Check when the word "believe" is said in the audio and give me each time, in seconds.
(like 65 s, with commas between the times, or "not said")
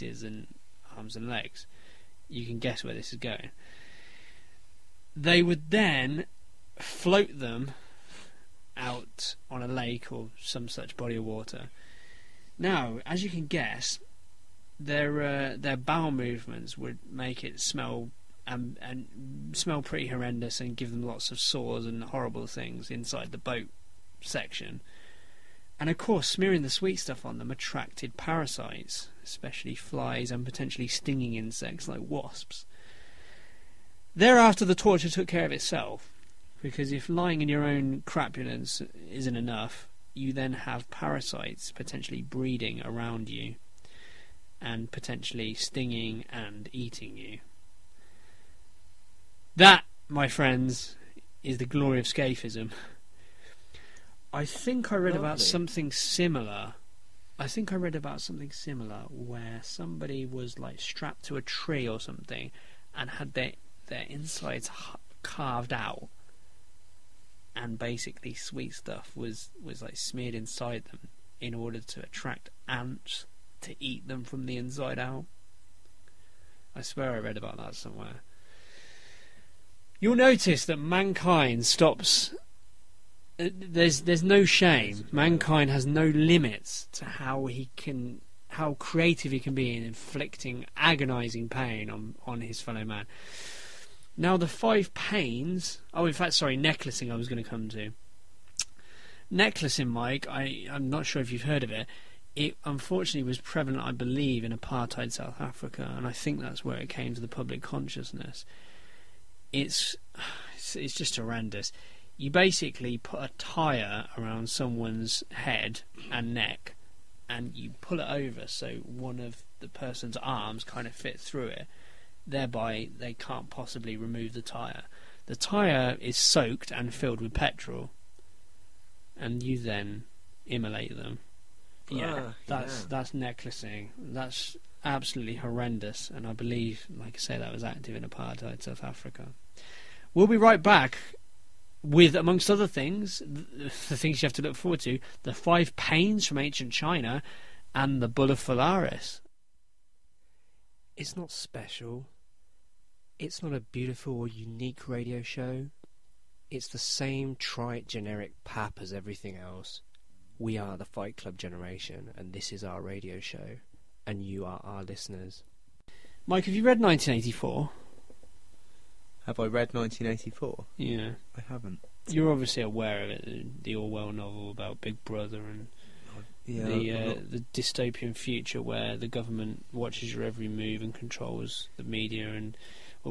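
103 s, 136 s.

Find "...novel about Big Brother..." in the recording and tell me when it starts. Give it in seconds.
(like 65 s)
174 s.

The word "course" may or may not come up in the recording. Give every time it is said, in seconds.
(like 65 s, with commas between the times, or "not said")
25 s.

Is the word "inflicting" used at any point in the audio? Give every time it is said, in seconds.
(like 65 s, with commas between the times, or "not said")
89 s.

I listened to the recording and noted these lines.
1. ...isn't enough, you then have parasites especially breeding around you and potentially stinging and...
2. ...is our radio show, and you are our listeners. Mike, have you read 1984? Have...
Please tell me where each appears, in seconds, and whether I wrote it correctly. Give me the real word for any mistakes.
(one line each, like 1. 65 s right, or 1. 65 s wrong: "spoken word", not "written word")
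1. 39 s wrong: "potentially", not "especially"
2. 162 s right.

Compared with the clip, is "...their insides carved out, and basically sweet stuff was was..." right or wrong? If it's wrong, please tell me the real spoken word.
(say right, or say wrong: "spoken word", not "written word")
right.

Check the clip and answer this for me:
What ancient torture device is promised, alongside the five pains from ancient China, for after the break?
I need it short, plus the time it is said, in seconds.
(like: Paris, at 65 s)
Bull of Phalaris, at 148 s.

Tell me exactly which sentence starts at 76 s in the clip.
I swear I read about that somewhere.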